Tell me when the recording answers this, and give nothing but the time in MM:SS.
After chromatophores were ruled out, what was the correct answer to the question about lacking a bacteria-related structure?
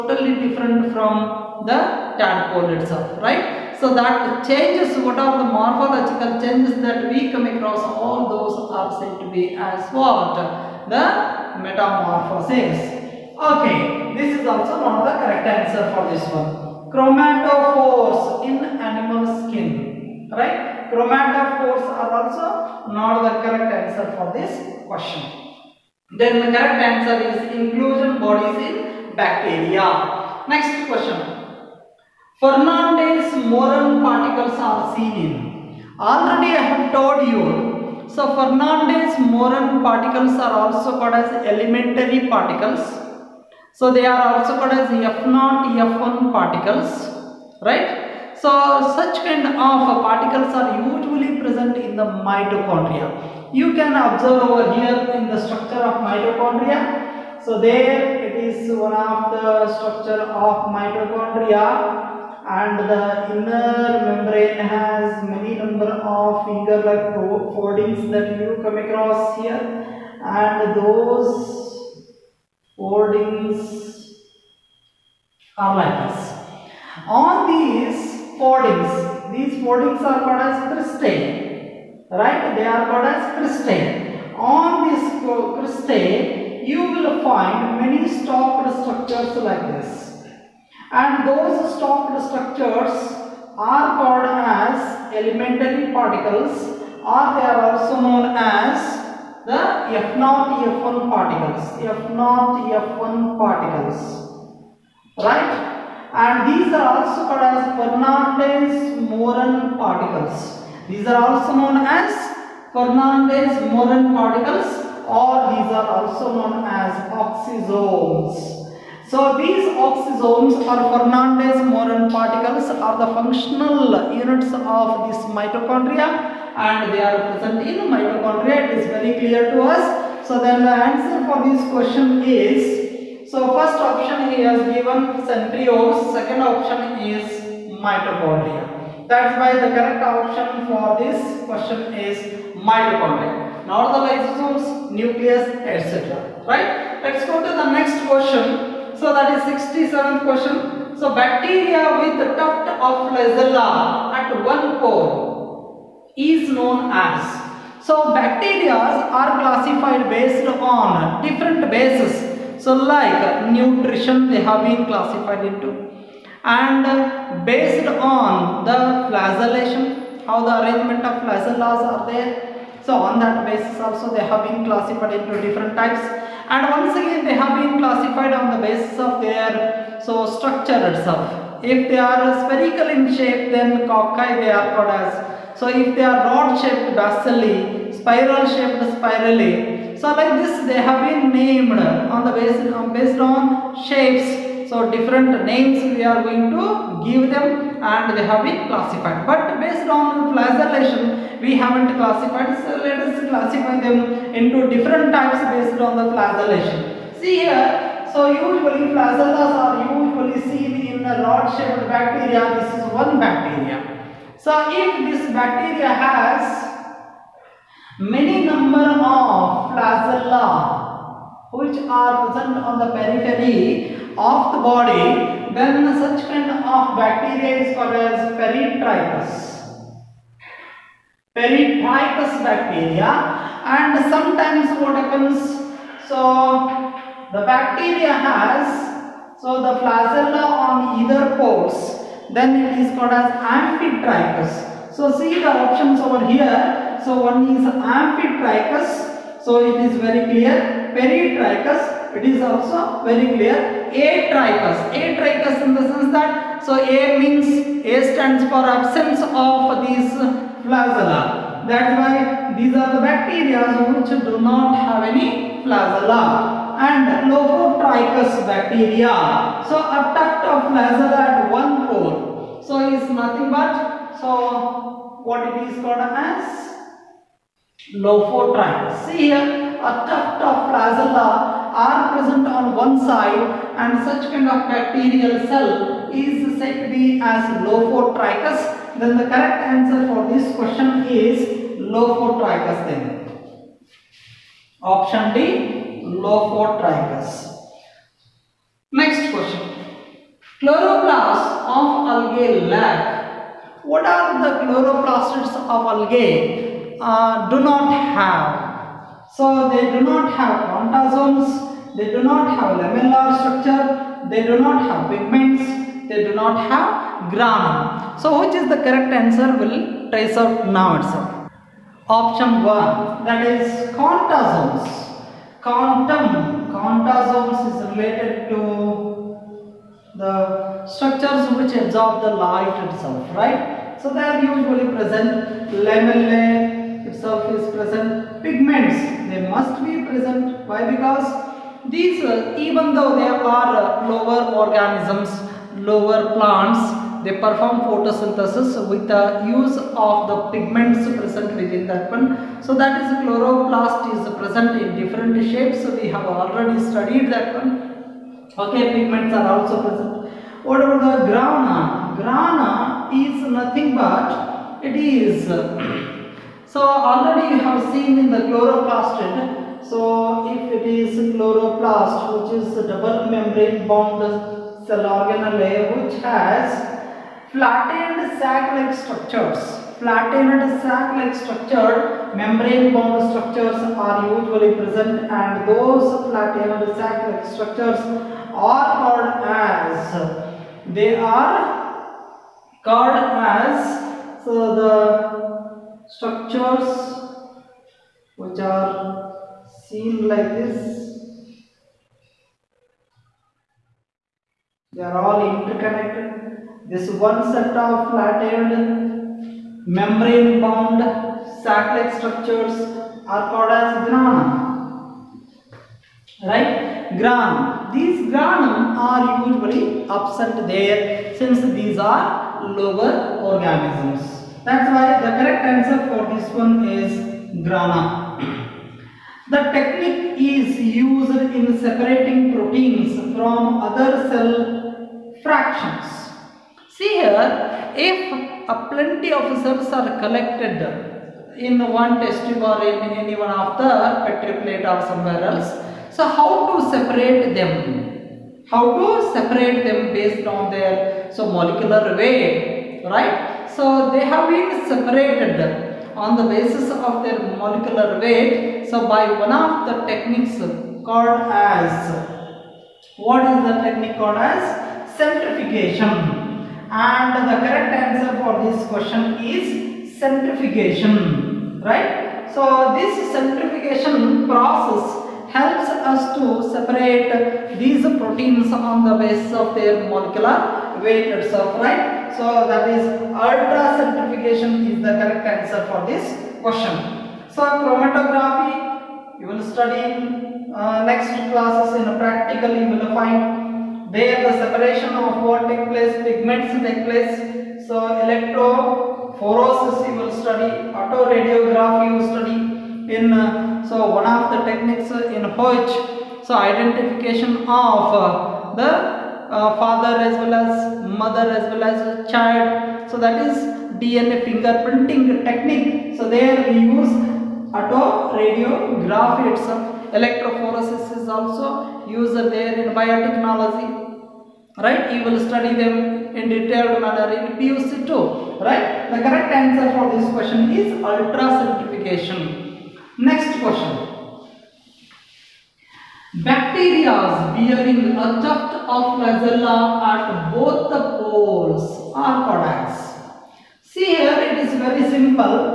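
00:27.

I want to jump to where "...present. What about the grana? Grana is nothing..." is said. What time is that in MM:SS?
05:59.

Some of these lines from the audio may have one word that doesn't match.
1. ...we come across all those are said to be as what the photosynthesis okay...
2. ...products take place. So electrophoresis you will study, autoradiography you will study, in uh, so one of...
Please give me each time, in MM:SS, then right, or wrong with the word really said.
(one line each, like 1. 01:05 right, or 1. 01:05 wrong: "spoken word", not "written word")
1. 00:07 wrong: "metamorphosis", not "photosynthesis"
2. 08:16 wrong: "pigments", not "products".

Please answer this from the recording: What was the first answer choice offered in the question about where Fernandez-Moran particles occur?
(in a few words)
Centriole.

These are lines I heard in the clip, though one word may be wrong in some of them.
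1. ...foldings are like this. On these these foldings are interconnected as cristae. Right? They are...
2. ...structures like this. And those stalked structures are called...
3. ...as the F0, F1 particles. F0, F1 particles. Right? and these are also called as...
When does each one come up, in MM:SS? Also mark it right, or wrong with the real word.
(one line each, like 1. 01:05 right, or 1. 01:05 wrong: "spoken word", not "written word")
1. 01:12 wrong: "called", not "interconnected"
2. 01:28 right
3. 01:38 right.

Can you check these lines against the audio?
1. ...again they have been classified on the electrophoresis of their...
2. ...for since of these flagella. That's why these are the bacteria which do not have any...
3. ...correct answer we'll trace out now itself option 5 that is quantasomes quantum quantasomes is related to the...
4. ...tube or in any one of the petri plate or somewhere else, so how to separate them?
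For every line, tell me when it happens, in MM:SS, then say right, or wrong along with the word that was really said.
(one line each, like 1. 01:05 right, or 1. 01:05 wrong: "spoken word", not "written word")
1. 02:57 wrong: "basis", not "electrophoresis"
2. 04:18 wrong: "absence", not "since"
3. 05:18 wrong: "1", not "5"
4. 07:22 right.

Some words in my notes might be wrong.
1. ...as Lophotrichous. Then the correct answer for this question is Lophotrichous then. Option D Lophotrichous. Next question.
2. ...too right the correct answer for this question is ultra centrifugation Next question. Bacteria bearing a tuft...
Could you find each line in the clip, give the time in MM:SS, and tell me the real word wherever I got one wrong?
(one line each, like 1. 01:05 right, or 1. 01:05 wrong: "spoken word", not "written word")
1. 04:47 right
2. 08:48 right.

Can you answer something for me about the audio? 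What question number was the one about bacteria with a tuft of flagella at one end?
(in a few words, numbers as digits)
67.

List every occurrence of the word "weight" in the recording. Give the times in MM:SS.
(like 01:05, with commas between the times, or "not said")
07:32, 07:38, 08:01.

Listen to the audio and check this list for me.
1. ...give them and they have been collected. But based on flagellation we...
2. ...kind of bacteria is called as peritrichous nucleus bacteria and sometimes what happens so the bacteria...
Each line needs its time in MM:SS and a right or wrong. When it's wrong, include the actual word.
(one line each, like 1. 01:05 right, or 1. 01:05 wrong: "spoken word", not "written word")
1. 03:17 wrong: "classified", not "collected"
2. 03:46 wrong: "peritrichous", not "nucleus".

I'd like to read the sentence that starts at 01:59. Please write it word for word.
So these oxysomes or Fernandez-Moran particles are the functional units of this mitochondria and they are present in mitochondria.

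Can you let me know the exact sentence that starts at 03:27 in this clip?
See here, so usually flagellas are usually seen in the rod-shaped bacteria.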